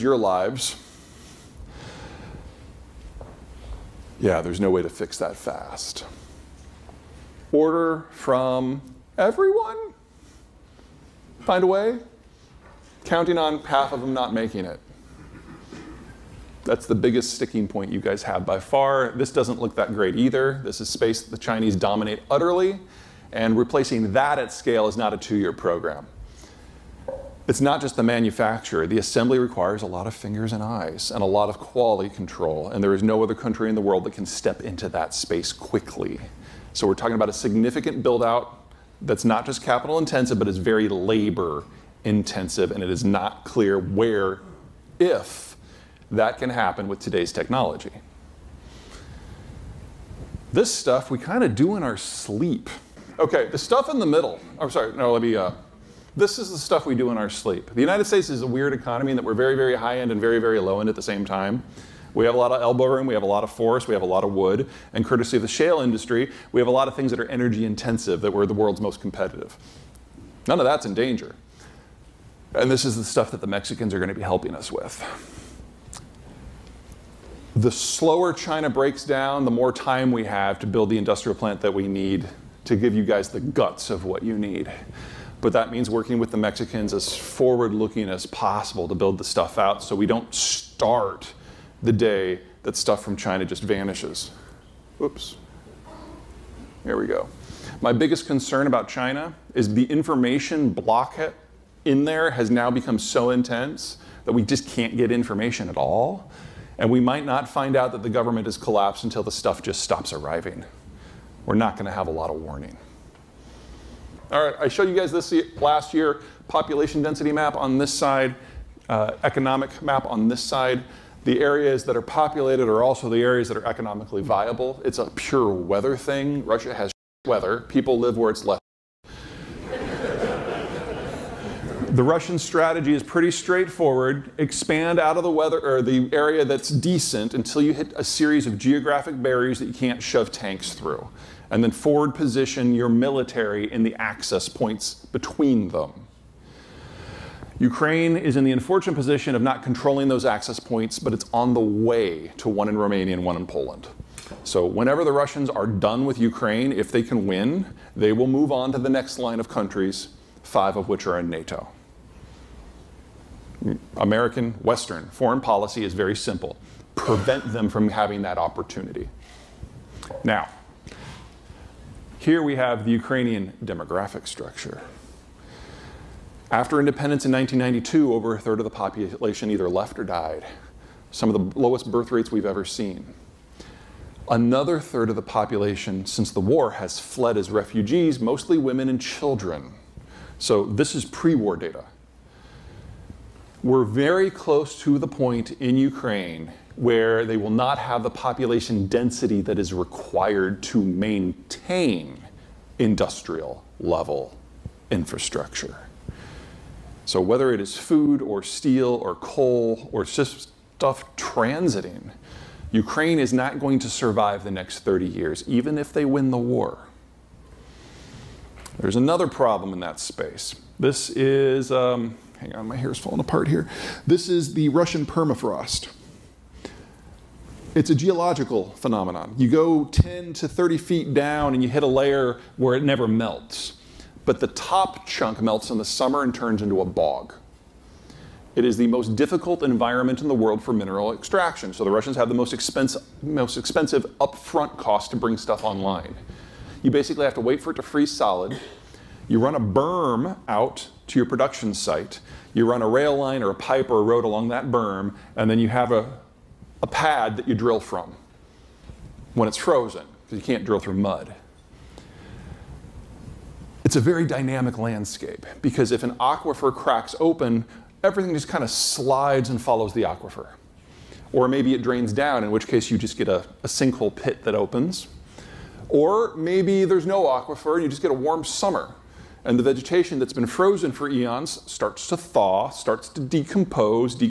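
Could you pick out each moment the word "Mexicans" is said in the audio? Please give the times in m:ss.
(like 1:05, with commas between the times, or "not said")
1:13, 1:26.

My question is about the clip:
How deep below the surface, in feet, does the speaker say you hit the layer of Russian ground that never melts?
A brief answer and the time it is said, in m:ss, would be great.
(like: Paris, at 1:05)
10 to 30 feet, at 3:49.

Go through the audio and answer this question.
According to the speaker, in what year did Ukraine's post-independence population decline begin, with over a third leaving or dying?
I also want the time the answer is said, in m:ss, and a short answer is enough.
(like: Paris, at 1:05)
1992, at 2:57.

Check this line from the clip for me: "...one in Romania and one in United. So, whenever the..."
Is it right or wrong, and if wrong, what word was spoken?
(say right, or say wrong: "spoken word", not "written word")
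wrong: "Poland", not "United".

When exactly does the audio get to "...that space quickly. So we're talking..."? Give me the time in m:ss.
0:34.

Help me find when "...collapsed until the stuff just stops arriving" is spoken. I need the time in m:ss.
1:48.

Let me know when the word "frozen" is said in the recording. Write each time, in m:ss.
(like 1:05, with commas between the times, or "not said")
4:19, 4:40.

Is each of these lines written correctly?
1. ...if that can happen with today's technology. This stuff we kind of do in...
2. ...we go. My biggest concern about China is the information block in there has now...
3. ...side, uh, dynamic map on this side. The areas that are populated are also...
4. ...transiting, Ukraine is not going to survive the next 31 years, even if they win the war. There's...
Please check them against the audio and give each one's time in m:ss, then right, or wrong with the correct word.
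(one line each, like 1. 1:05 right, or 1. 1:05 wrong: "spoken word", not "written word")
1. 0:44 right
2. 1:36 right
3. 1:57 wrong: "economic", not "dynamic"
4. 3:31 wrong: "30", not "31".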